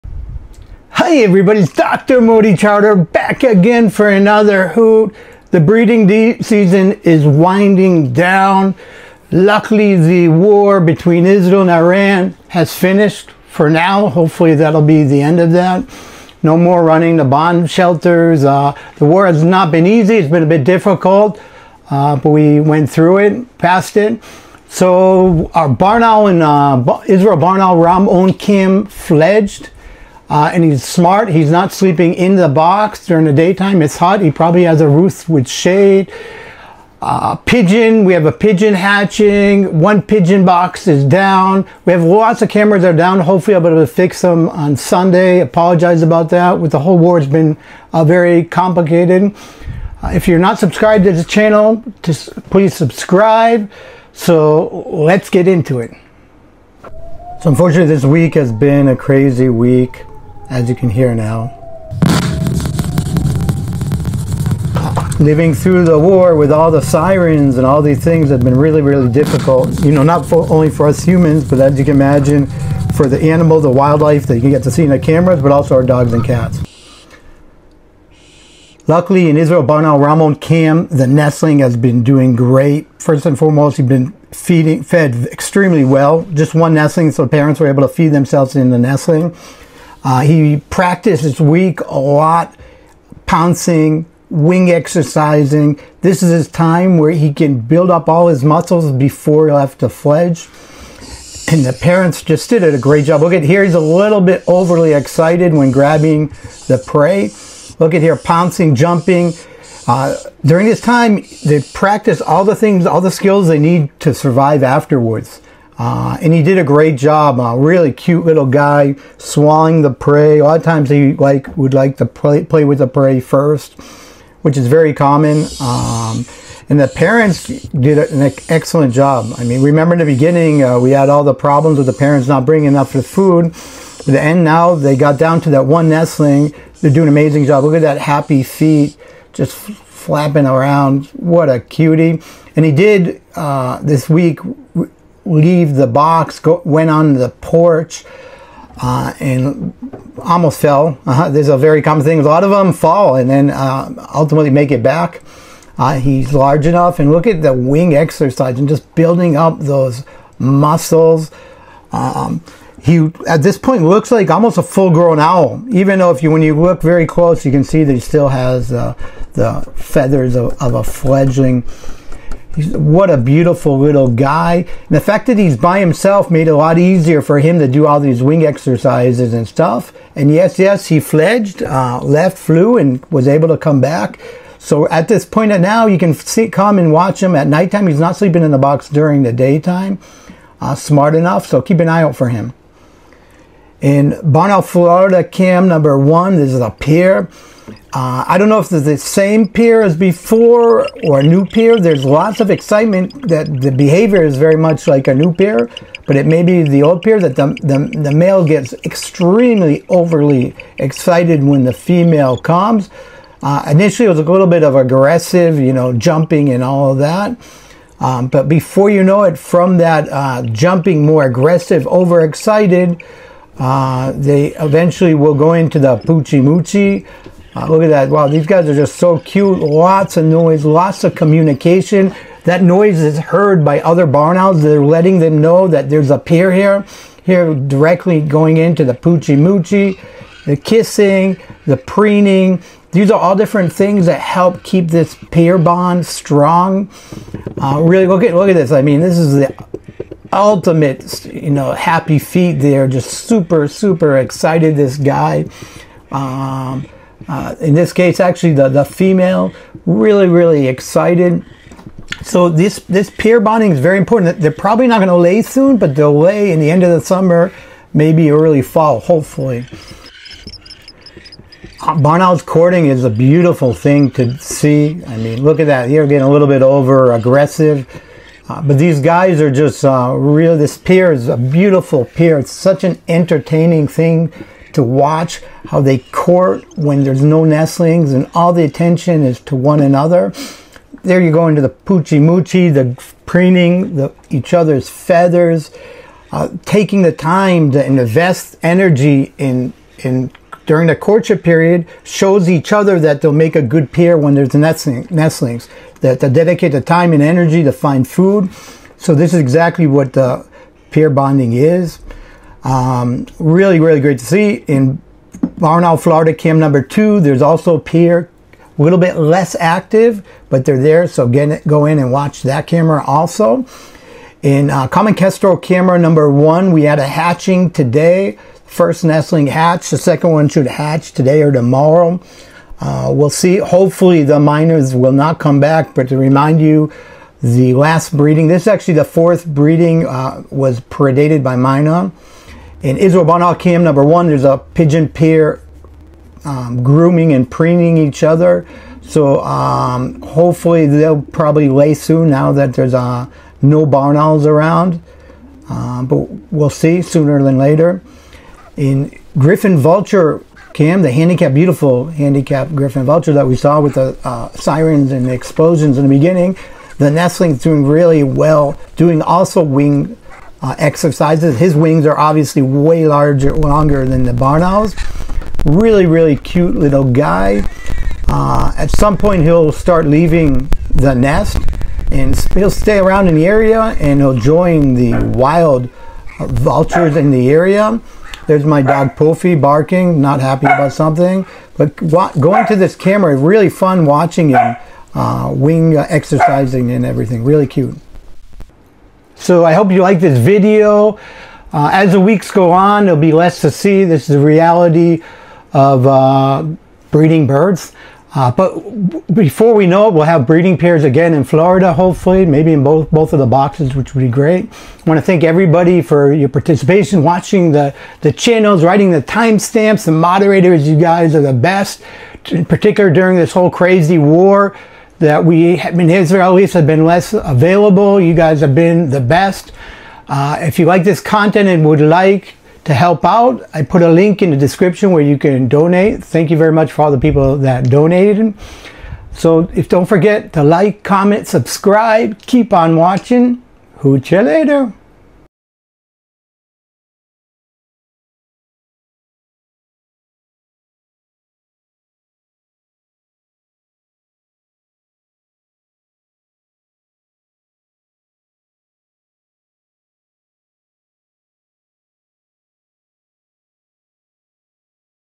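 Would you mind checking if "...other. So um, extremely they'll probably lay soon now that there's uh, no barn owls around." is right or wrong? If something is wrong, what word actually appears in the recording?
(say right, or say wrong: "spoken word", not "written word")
wrong: "hopefully", not "extremely".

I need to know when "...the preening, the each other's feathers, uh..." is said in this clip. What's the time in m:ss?
4:52.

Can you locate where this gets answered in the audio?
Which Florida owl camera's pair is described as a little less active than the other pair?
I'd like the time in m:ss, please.
5:15.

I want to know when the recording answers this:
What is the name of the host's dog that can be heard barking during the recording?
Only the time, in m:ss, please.
6:29.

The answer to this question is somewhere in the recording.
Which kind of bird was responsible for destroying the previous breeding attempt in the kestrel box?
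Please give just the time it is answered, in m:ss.
5:41.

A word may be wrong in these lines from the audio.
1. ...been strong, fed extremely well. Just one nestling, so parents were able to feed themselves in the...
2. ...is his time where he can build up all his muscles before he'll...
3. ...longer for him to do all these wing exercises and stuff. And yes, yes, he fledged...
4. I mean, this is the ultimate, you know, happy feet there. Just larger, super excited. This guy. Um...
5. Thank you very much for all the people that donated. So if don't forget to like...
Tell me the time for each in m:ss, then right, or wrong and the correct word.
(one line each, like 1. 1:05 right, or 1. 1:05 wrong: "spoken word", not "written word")
1. 1:23 wrong: "feeding", not "strong"
2. 1:36 right
3. 2:56 wrong: "easier", not "longer"
4. 4:08 wrong: "super", not "larger"
5. 7:16 right.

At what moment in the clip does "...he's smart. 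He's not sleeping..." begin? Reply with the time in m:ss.
0:30.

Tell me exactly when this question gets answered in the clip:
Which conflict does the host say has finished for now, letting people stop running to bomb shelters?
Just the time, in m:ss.
0:10.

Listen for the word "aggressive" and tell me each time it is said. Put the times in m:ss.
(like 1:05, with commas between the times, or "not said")
3:34, 3:41, 4:37.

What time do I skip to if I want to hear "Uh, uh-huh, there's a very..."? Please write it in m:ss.
2:31.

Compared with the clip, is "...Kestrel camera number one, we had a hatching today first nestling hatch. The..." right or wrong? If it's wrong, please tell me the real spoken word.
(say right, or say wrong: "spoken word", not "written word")
right.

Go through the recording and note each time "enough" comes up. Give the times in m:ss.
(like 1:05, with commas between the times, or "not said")
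2:12, 2:36, 3:11.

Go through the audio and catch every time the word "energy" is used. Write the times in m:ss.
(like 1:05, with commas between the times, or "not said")
4:58, 5:07.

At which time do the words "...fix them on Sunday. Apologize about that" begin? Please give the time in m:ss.
0:43.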